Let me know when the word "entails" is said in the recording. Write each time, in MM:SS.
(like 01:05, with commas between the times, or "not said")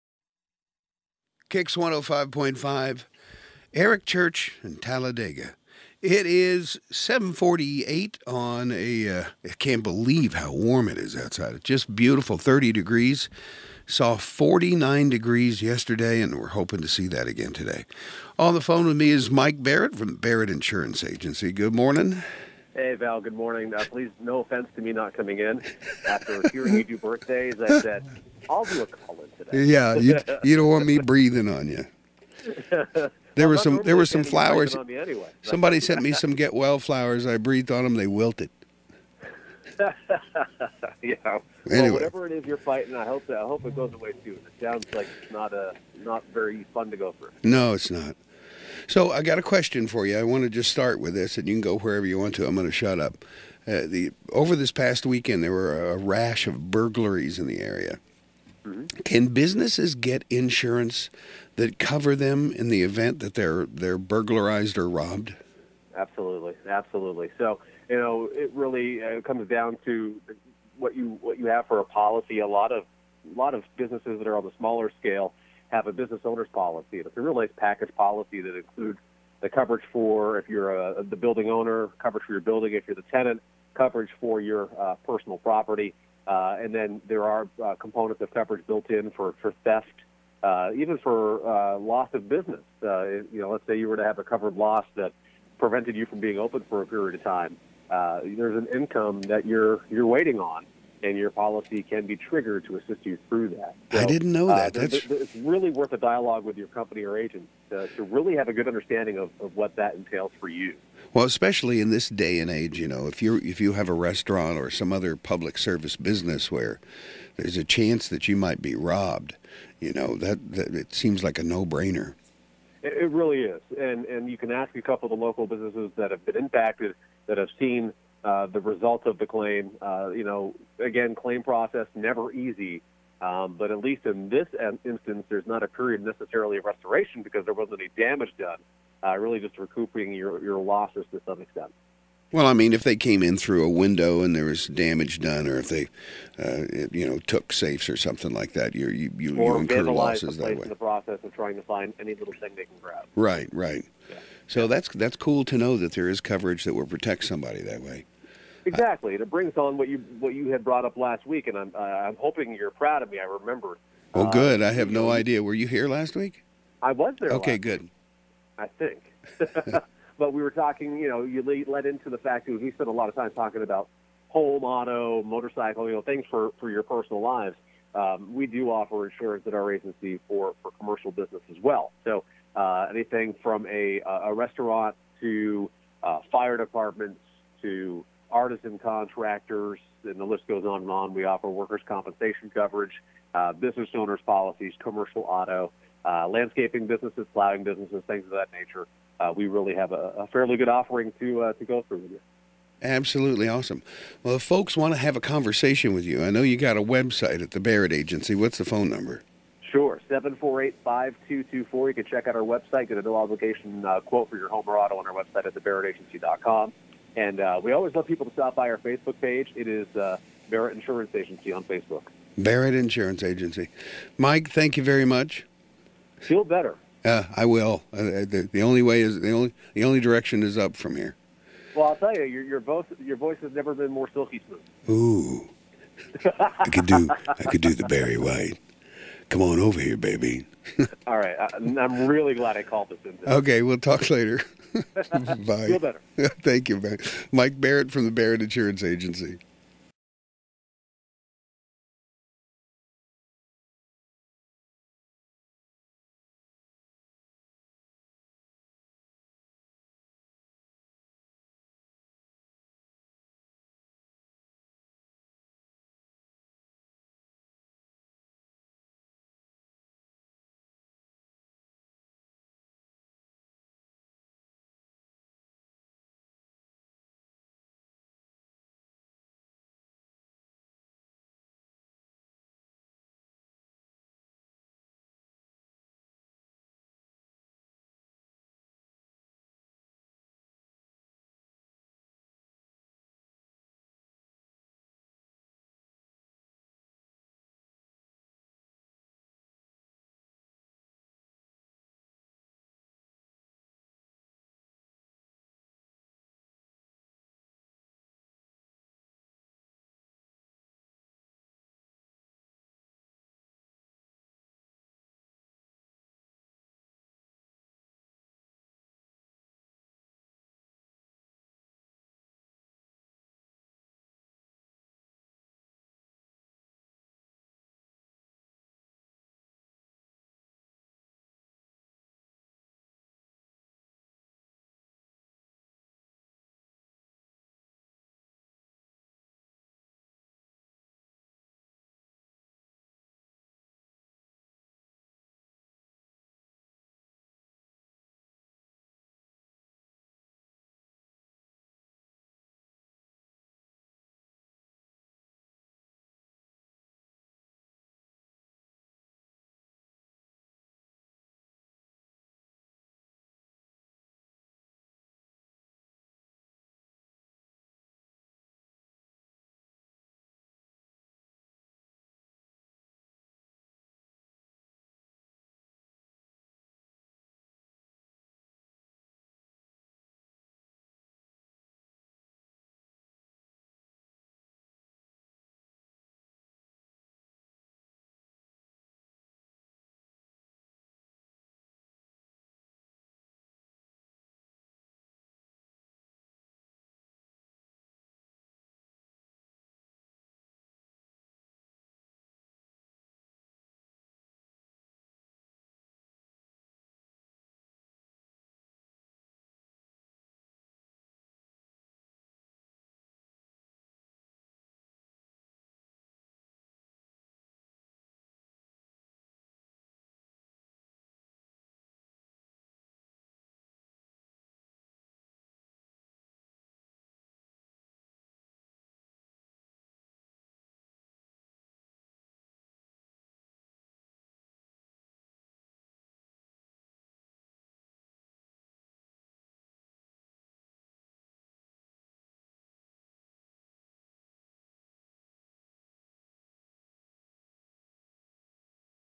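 01:49.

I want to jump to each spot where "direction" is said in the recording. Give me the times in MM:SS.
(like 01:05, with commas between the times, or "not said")
03:49.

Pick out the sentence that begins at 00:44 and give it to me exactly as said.
It sounds like it's not a not very fun to go through.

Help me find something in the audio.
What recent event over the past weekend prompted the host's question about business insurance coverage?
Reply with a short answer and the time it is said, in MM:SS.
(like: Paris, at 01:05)
rash of burglaries, at 00:55.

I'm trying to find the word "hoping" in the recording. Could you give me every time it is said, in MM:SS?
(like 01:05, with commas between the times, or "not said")
00:16, 02:42.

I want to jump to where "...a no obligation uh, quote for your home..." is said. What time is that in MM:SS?
03:32.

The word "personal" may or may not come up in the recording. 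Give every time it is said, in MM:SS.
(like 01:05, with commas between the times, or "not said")
01:25, 02:56.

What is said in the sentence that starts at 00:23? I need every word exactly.
Uh, please, no offense to me not coming in.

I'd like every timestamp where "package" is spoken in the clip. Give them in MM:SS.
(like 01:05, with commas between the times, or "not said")
01:17.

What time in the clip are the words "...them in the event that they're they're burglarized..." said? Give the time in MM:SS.
01:02.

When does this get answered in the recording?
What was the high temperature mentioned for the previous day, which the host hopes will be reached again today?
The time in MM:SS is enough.
00:14.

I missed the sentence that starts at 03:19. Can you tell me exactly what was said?
Uh, we really have a, a, fairly good offering to uh, to go through with you.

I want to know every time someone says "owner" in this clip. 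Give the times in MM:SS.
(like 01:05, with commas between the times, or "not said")
01:16, 01:21, 03:13.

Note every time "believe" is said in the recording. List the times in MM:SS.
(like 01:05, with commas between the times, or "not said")
00:09.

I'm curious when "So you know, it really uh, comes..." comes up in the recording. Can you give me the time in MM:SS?
01:07.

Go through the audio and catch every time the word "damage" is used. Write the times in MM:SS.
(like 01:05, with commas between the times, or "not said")
02:17, 02:24.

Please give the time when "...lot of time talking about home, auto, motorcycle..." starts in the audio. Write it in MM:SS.
02:52.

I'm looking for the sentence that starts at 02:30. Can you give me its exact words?
In the process of trying to find any little thing they can grab.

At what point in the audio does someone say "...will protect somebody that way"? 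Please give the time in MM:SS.
02:36.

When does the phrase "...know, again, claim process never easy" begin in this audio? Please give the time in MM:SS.
02:10.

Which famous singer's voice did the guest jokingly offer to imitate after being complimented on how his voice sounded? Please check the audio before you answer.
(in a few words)
Barry White.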